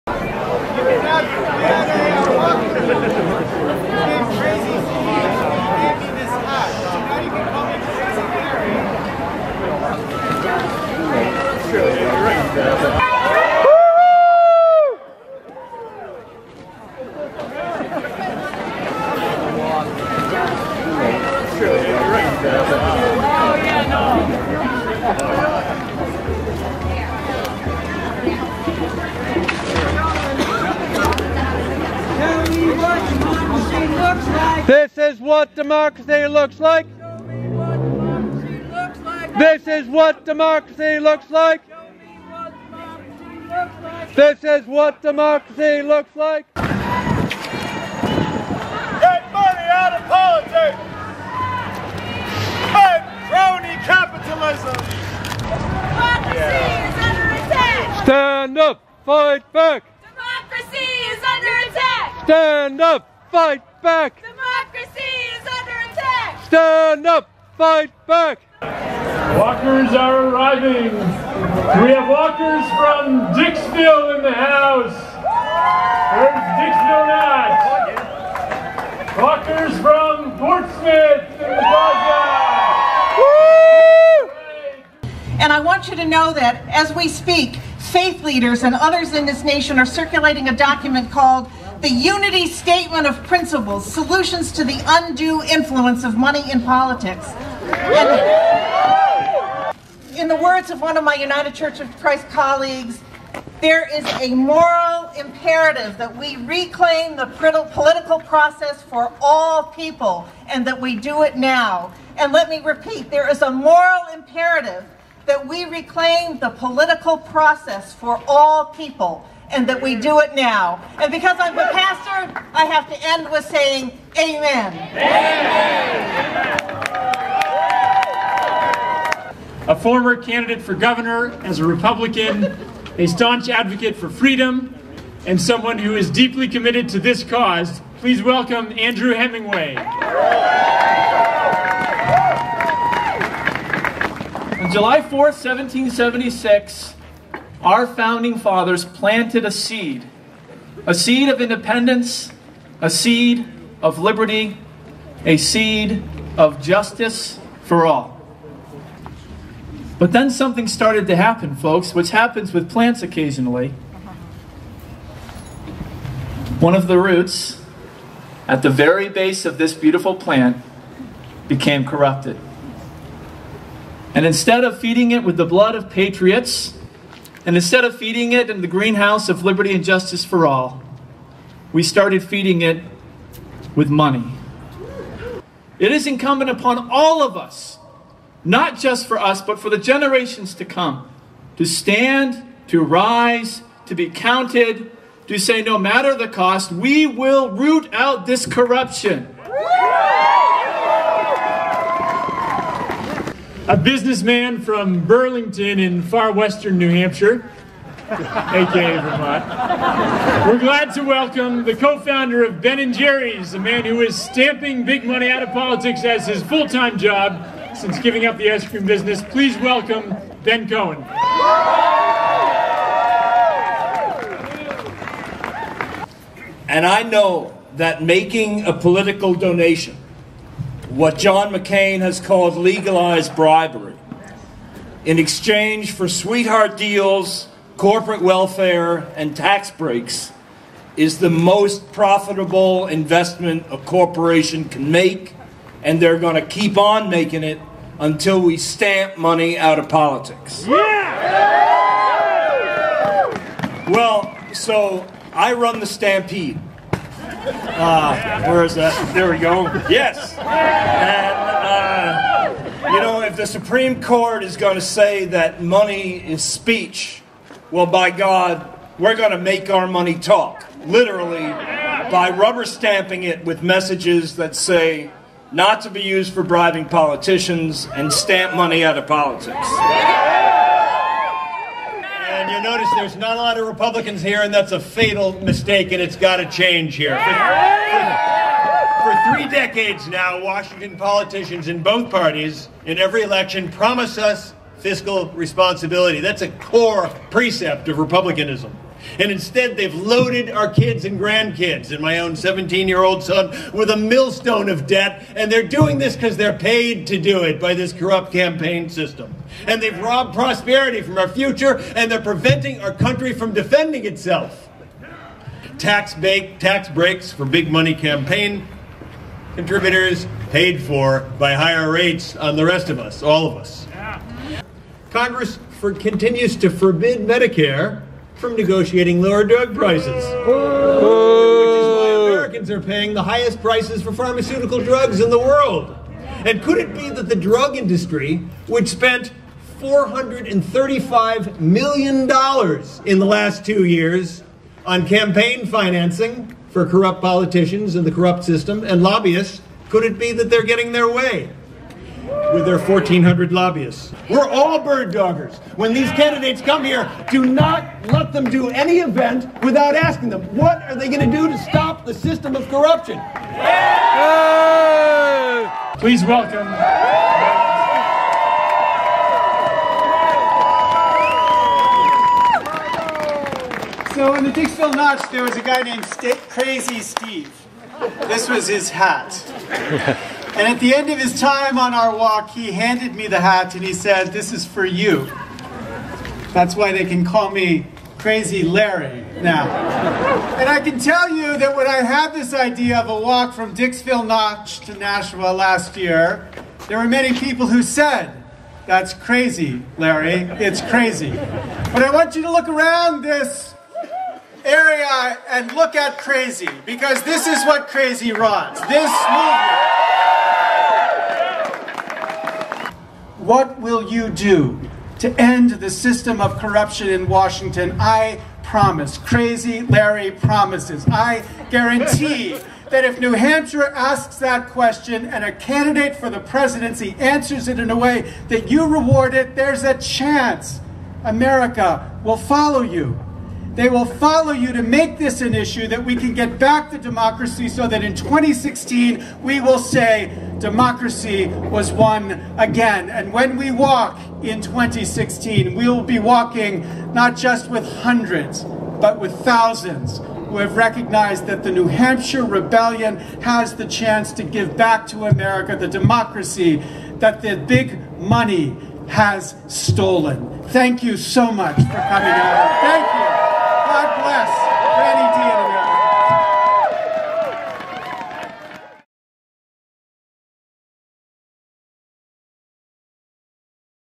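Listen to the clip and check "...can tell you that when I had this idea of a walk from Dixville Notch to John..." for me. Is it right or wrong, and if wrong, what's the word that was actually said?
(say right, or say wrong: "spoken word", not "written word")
wrong: "Nashua", not "John".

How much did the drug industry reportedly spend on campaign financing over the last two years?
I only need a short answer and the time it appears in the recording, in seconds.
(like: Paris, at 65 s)
$435 million, at 339 s.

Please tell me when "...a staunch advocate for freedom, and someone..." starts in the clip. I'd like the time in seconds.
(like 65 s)
132 s.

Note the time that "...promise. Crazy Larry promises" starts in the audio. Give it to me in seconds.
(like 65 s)
418 s.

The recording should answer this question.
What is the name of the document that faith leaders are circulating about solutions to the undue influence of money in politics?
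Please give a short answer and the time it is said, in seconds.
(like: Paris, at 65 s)
Unity statement of principles, at 91 s.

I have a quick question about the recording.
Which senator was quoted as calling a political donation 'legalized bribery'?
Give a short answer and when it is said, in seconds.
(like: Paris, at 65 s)
John McCain, at 231 s.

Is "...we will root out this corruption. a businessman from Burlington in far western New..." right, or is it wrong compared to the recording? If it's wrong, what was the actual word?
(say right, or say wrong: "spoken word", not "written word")
right.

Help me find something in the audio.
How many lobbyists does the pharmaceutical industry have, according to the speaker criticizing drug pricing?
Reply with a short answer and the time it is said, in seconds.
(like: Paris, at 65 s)
1,400, at 352 s.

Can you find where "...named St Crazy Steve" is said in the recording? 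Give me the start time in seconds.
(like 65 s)
375 s.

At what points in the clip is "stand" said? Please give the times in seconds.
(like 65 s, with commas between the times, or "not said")
58 s, 62 s, 66 s, 191 s.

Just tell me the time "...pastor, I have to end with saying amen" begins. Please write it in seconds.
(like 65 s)
121 s.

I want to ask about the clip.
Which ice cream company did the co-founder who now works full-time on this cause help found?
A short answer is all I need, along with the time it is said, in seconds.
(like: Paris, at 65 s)
Ben and Jerry's, at 212 s.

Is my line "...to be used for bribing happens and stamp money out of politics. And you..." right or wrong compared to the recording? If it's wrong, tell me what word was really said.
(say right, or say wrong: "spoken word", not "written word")
wrong: "politicians", not "happens".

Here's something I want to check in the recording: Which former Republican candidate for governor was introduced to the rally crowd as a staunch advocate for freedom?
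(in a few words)
Andrew Hemingway.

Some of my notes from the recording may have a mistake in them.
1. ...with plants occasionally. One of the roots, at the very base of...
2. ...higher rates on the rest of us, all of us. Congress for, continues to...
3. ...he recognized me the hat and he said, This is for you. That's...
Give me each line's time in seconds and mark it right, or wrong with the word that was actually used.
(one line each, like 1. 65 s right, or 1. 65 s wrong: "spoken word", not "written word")
1. 162 s right
2. 321 s right
3. 382 s wrong: "handed", not "recognized".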